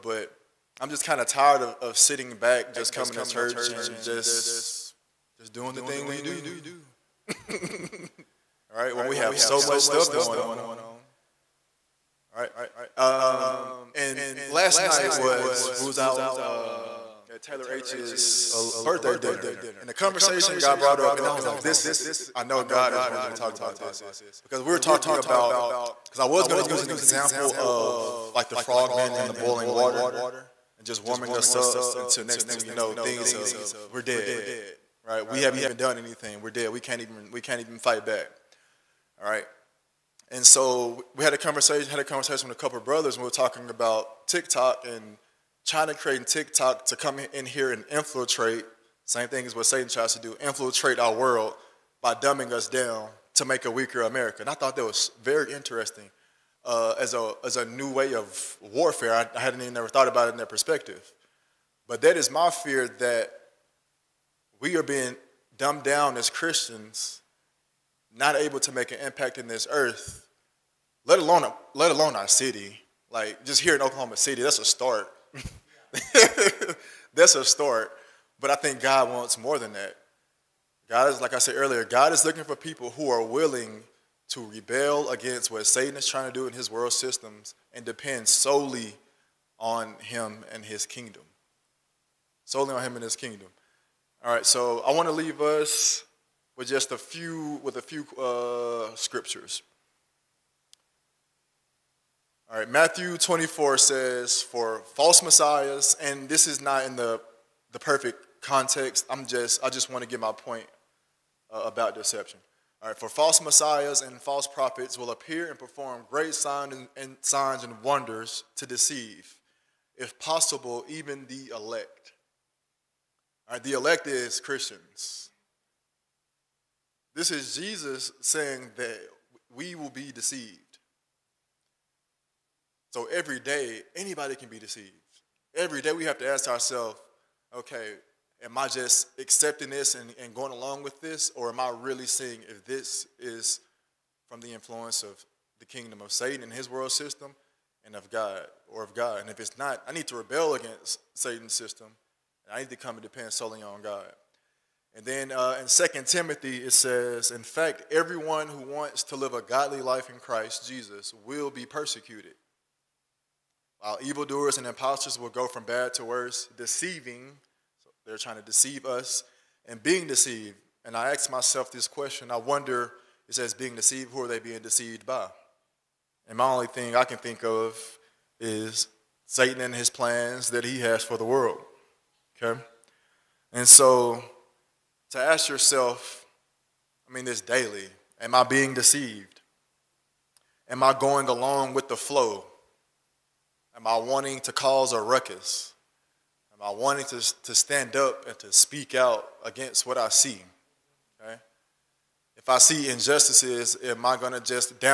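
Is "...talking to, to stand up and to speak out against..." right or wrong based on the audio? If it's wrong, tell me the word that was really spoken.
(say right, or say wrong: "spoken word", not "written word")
wrong: "wanting", not "talking".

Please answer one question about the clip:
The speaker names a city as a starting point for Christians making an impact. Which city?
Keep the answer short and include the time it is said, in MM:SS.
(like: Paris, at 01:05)
Oklahoma City, at 01:13.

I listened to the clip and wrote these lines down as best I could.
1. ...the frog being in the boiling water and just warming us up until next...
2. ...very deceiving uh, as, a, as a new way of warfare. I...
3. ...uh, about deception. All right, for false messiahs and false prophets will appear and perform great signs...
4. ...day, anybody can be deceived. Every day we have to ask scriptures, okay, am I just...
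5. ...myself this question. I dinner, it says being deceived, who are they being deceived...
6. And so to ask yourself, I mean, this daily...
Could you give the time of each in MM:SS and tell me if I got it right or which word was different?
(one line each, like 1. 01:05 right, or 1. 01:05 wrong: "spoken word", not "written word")
1. 00:28 right
2. 00:55 wrong: "interesting", not "deceiving"
3. 01:51 right
4. 02:13 wrong: "ourselves", not "scriptures"
5. 02:51 wrong: "wonder", not "dinner"
6. 03:03 right.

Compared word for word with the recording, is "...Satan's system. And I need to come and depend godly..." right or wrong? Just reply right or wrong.
wrong.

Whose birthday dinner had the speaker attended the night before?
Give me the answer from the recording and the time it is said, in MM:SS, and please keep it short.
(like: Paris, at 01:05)
Taylor H, at 00:17.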